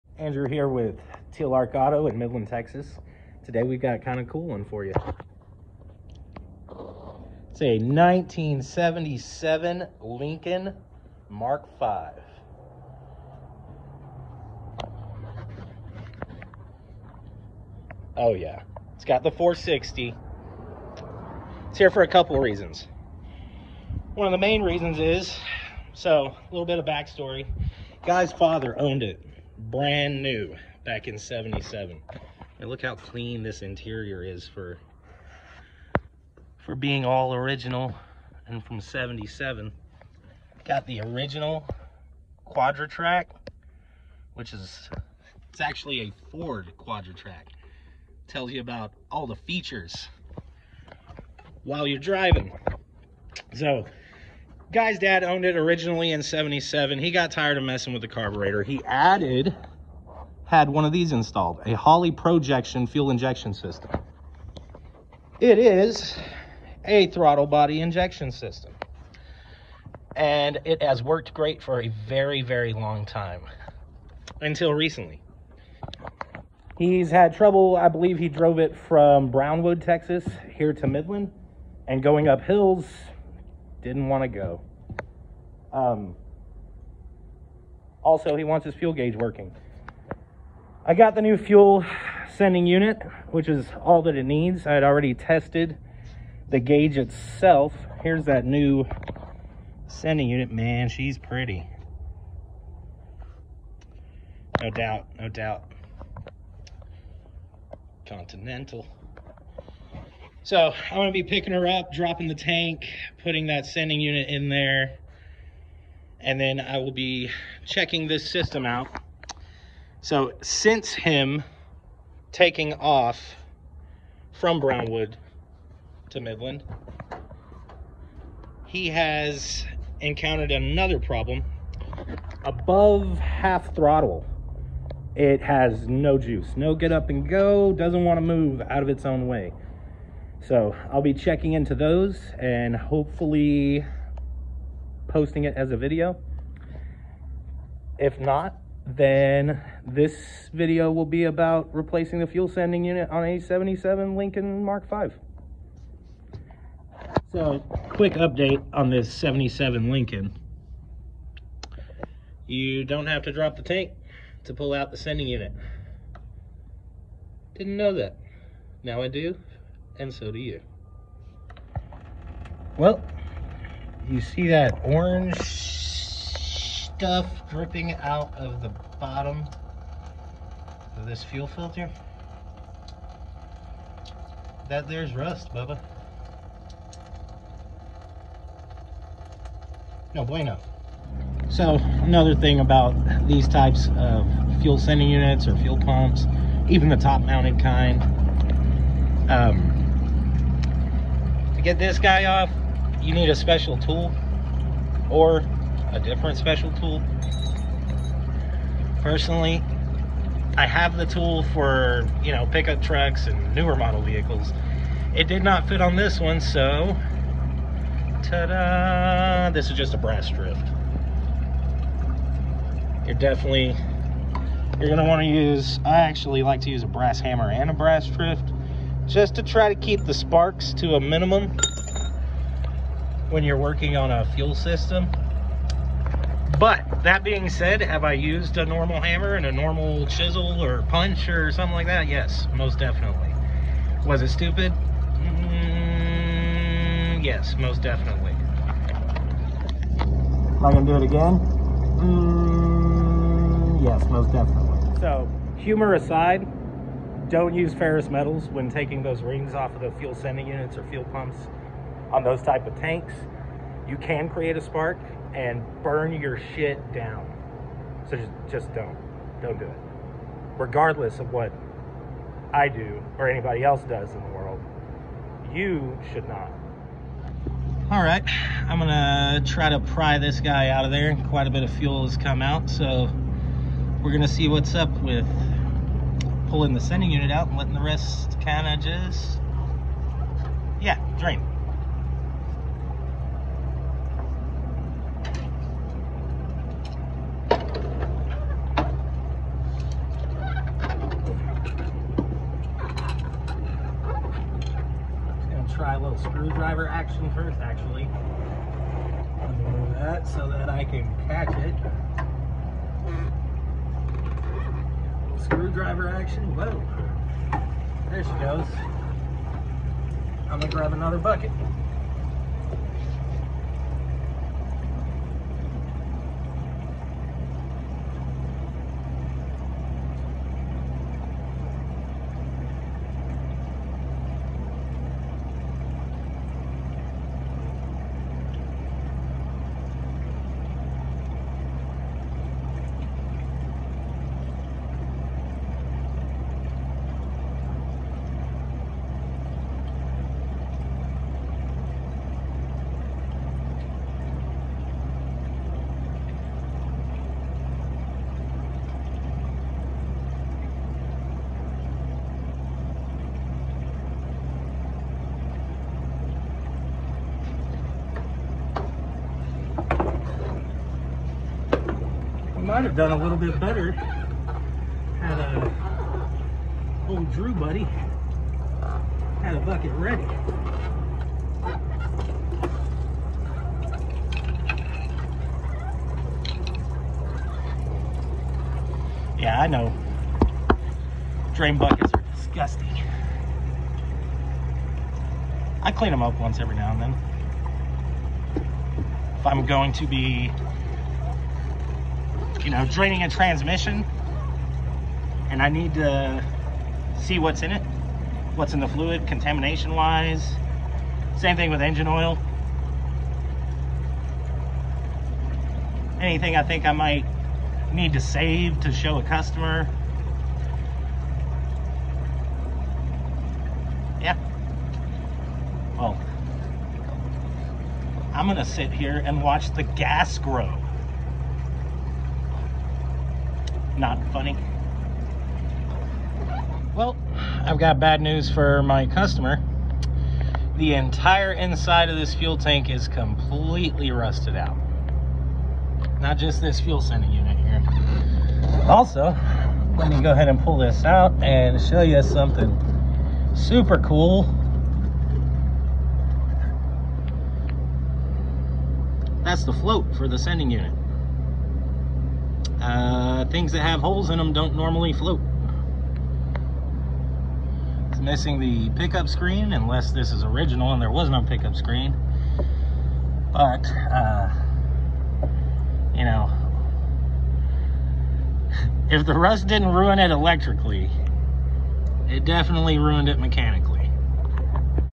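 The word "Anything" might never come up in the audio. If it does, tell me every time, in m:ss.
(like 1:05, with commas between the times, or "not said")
6:56.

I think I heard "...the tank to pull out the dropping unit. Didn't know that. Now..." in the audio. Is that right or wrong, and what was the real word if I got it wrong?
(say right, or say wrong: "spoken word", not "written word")
wrong: "sending", not "dropping".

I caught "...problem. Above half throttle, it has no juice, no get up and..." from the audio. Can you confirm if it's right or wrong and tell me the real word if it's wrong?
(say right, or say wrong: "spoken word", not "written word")
right.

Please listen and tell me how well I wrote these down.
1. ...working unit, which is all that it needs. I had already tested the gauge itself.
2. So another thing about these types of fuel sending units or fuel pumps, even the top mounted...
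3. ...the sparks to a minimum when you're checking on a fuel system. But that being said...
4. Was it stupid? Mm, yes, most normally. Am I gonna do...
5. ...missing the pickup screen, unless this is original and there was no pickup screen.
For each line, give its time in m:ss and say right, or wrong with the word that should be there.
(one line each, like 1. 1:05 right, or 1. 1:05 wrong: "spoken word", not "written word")
1. 1:32 wrong: "sending", not "working"
2. 3:11 right
3. 3:50 wrong: "working", not "checking"
4. 4:04 wrong: "definitely", not "normally"
5. 7:48 right.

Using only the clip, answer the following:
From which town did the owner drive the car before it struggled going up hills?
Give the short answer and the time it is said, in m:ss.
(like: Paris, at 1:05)
Brownwood, Texas, at 1:19.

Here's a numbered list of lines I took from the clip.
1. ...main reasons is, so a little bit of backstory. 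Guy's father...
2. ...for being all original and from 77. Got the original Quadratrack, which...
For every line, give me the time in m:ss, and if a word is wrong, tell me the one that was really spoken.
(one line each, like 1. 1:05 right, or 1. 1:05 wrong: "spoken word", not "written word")
1. 0:24 right
2. 0:36 right.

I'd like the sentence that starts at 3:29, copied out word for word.
Personally, I have the tool for, you know, pickup trucks and newer model vehicles.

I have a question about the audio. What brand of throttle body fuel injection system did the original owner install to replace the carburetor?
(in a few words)
Holley Pro-Jection.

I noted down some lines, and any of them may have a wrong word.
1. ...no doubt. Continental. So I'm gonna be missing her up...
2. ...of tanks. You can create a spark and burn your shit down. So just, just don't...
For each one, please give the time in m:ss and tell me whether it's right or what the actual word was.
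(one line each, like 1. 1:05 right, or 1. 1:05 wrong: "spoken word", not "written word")
1. 1:45 wrong: "picking", not "missing"
2. 4:22 right.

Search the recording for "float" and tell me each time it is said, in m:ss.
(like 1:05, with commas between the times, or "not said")
7:39, 7:45.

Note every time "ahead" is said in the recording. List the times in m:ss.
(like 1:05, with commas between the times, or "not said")
7:30.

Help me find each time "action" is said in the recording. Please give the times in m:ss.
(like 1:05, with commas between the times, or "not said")
5:06, 5:16.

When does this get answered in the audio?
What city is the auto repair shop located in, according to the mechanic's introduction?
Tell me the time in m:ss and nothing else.
0:02.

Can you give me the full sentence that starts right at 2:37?
So, quick update on this 77 Lincoln.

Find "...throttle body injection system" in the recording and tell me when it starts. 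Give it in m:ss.
1:07.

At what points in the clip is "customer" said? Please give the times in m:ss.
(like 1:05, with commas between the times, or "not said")
6:59, 7:19.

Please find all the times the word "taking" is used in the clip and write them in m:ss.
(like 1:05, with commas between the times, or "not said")
2:02, 4:18.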